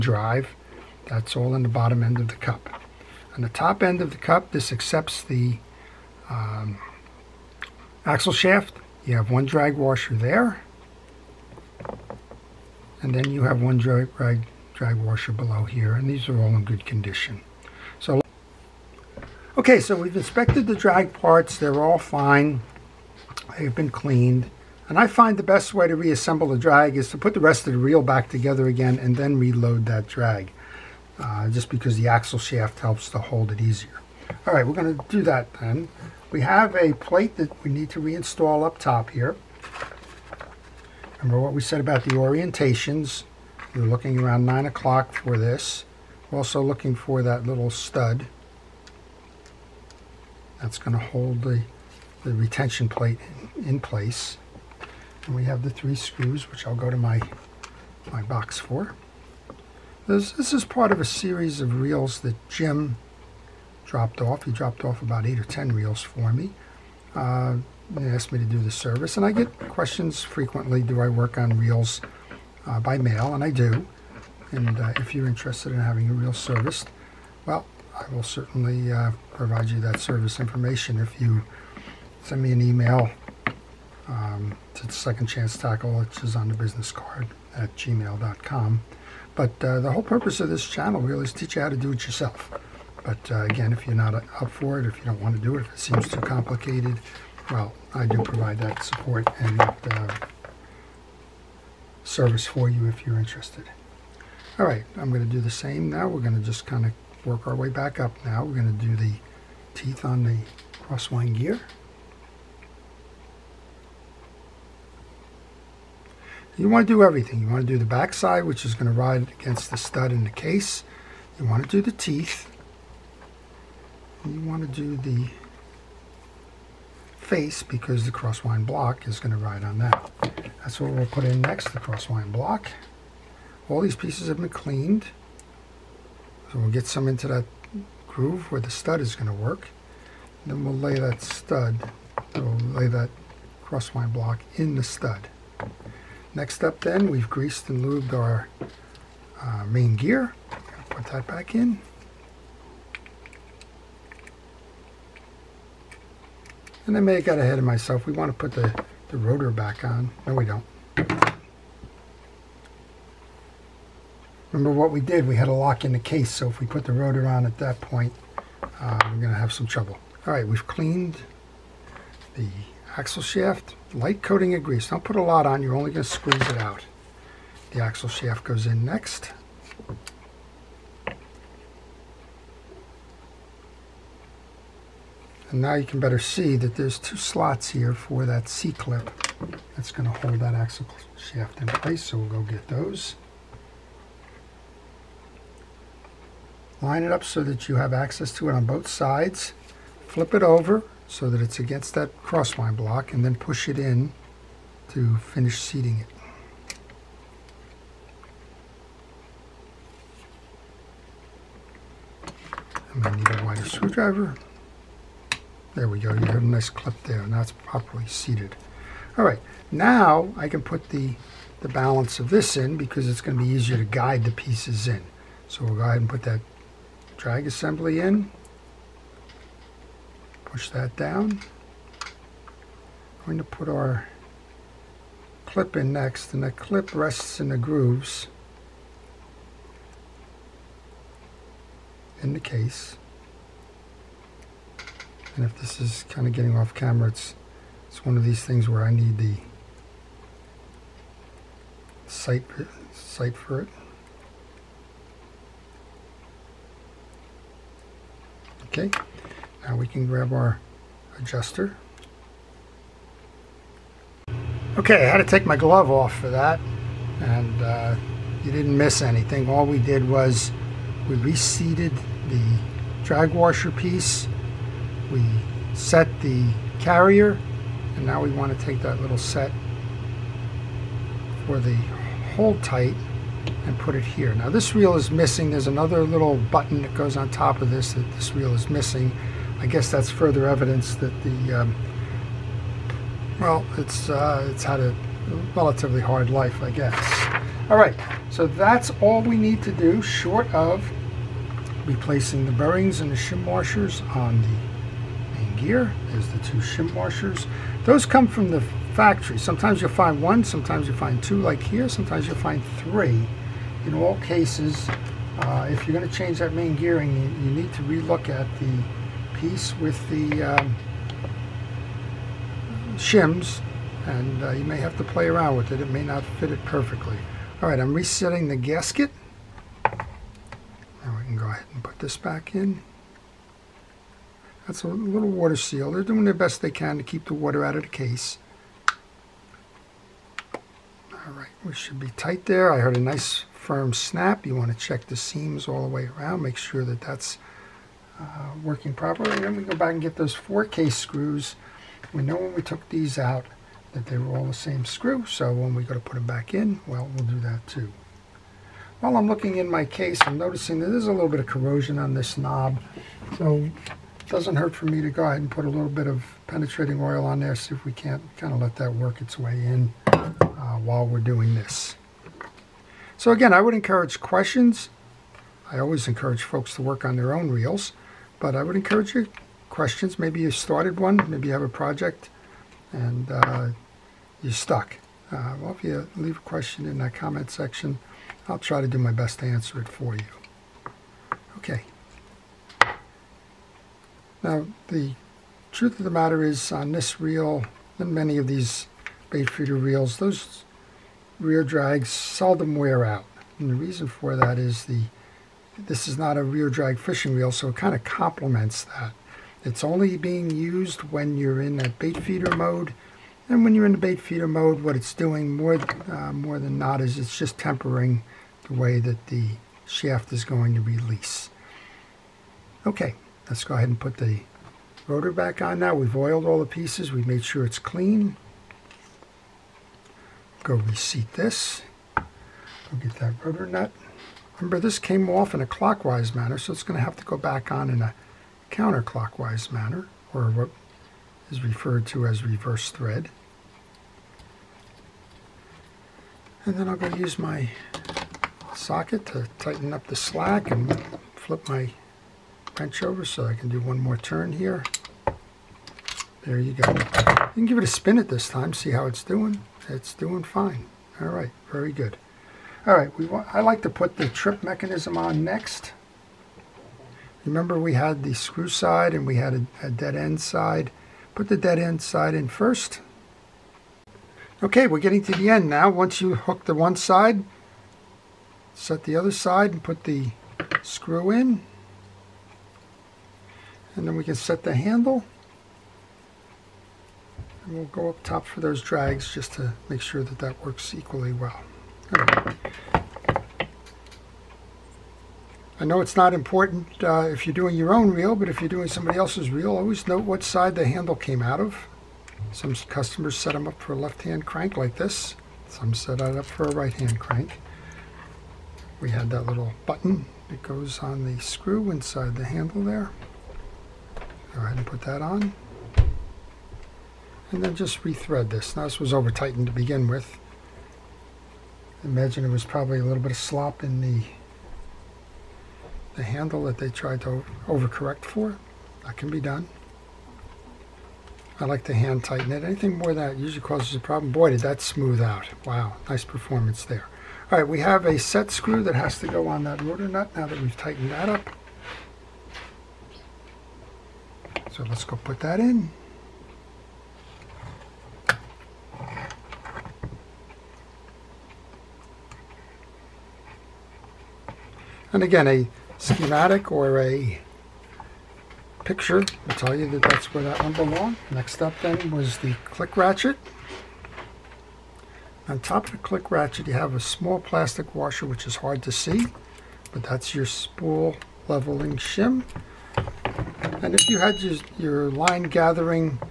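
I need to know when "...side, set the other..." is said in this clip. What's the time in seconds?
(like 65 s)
476 s.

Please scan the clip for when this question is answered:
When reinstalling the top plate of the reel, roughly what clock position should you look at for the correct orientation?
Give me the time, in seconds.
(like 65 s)
44 s.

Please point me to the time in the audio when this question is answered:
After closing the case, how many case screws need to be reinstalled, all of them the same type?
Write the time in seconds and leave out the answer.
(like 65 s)
350 s.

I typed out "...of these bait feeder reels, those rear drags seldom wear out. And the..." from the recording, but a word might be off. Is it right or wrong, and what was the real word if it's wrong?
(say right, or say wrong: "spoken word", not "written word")
right.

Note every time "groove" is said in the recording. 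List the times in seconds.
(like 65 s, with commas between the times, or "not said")
138 s, 237 s.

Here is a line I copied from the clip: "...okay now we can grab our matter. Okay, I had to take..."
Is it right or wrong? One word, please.
wrong.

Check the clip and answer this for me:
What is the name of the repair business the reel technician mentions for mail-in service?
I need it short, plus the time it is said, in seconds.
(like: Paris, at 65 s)
Second Chance Tackle, at 84 s.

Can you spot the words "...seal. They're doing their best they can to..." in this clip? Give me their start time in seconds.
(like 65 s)
335 s.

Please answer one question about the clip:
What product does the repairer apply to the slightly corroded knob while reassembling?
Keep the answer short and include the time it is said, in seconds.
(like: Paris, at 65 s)
penetrating oil, at 366 s.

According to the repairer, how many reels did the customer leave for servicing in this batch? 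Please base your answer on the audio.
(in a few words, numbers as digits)
eight or ten.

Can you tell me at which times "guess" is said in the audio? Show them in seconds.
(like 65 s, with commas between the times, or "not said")
289 s, 296 s.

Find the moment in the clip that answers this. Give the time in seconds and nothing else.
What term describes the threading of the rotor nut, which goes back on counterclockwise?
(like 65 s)
442 s.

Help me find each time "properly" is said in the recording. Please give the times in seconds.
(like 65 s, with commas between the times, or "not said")
217 s, 348 s.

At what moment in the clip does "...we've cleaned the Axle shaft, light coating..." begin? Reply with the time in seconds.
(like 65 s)
170 s.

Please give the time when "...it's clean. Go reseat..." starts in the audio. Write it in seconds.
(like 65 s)
427 s.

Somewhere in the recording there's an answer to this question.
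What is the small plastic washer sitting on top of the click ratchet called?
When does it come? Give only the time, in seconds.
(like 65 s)
570 s.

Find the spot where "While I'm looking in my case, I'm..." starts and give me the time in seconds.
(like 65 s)
359 s.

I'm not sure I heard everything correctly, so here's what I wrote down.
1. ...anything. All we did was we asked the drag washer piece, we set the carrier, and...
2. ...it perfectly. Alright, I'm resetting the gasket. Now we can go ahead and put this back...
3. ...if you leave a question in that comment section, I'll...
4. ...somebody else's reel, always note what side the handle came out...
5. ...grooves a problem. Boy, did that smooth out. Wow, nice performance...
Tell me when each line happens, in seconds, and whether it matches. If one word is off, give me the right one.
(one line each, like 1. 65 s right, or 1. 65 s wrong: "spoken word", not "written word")
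1. 269 s wrong: "reseated", not "asked"
2. 326 s right
3. 385 s right
4. 498 s right
5. 533 s wrong: "causes", not "grooves".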